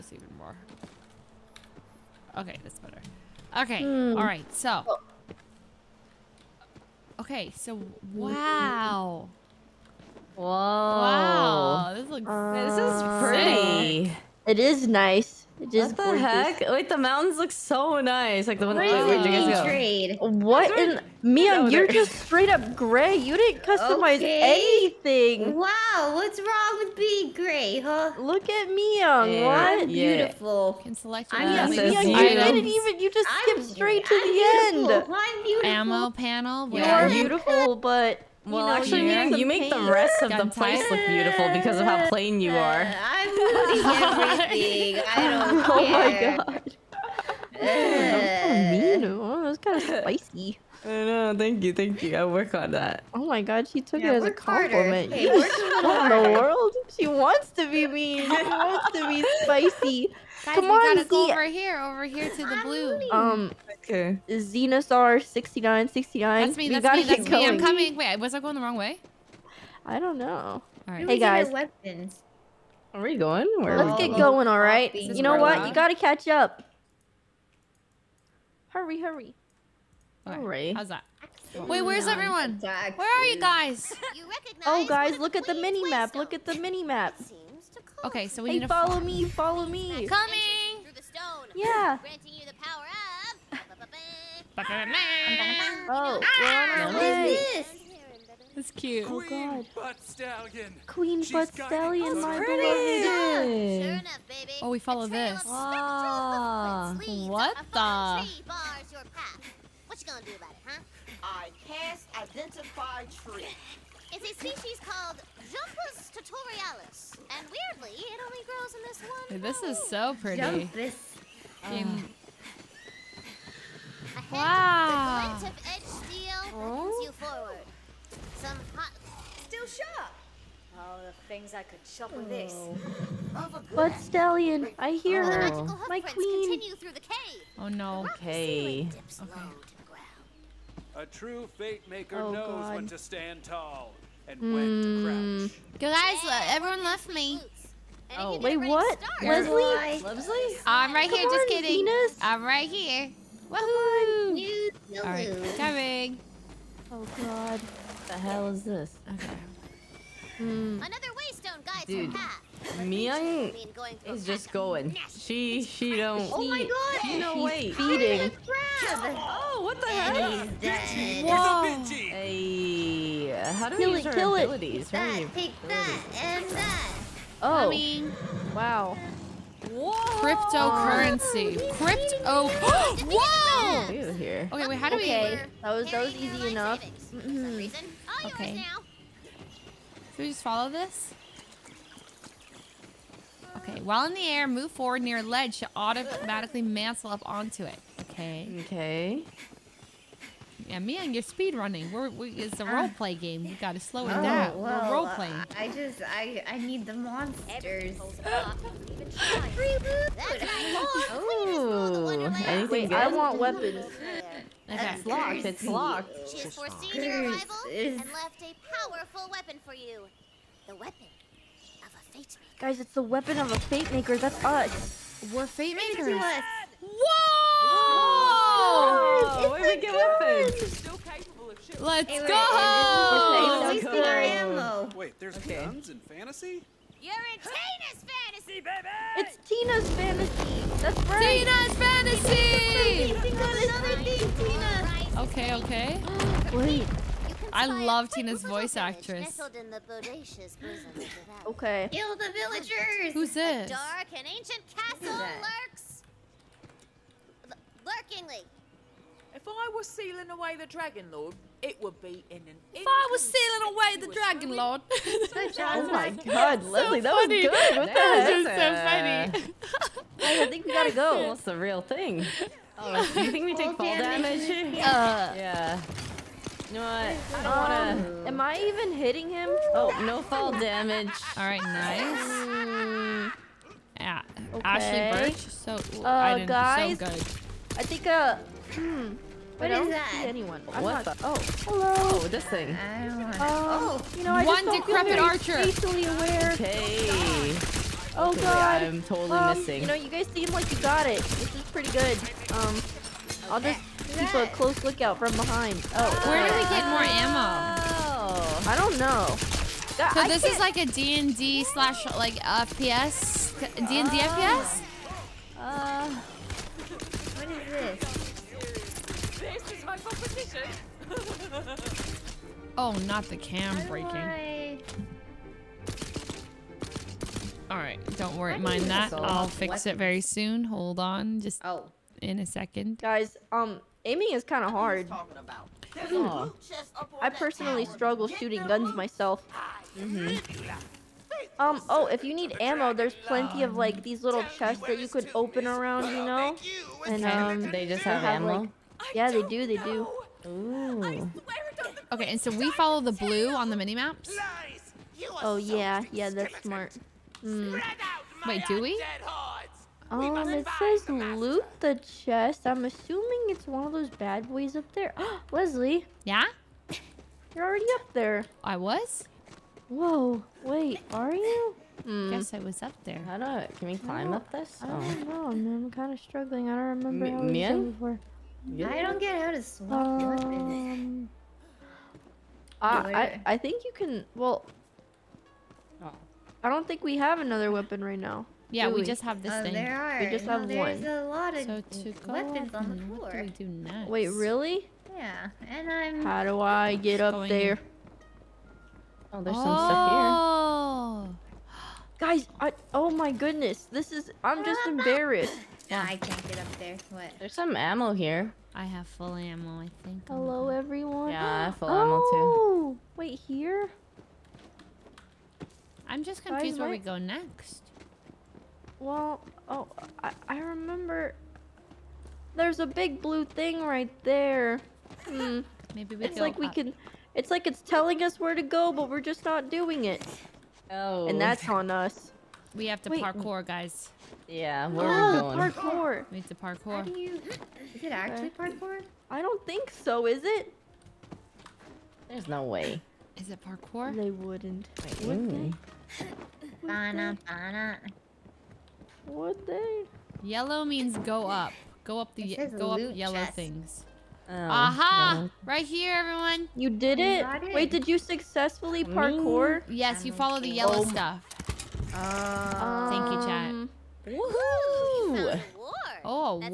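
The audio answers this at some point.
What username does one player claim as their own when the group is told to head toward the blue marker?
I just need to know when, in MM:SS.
01:04.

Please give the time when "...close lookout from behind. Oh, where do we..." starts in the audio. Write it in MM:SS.
05:04.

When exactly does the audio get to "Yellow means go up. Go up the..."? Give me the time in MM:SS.
07:30.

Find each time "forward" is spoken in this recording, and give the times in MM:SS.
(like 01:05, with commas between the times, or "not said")
02:07, 03:14.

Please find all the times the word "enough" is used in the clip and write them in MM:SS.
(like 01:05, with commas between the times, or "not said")
01:43, 03:06.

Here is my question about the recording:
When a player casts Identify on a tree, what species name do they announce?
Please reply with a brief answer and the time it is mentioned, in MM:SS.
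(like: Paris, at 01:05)
Jumpus tutorialis, at 01:55.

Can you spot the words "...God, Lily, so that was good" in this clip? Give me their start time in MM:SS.
04:26.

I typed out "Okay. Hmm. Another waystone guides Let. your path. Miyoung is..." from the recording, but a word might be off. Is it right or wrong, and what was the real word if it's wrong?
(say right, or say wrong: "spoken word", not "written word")
wrong: "Dude", not "Let".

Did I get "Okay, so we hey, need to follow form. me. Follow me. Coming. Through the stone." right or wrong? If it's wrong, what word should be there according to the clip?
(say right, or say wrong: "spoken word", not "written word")
right.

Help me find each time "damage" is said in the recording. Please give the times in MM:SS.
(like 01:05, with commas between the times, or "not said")
04:33, 04:40.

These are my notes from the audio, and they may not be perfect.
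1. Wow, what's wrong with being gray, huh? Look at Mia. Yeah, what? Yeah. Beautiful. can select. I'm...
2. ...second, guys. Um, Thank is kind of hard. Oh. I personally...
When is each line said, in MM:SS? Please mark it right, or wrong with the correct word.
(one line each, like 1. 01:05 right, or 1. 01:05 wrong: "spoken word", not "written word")
1. 00:25 right
2. 05:32 wrong: "Aiming", not "Thank".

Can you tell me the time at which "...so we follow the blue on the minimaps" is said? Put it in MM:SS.
05:52.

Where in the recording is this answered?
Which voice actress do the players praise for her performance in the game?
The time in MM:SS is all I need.
04:44.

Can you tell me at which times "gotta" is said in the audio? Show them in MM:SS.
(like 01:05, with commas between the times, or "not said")
01:00, 01:15, 03:23, 04:30.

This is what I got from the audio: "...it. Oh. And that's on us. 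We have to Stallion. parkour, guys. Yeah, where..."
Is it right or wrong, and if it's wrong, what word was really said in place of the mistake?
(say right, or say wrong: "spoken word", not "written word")
wrong: "Wait", not "Stallion".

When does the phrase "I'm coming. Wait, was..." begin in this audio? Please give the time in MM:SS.
01:07.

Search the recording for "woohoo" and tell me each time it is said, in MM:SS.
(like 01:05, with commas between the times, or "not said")
02:33, 07:44.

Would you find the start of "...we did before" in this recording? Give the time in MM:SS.
06:17.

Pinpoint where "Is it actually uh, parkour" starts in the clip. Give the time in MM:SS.
07:17.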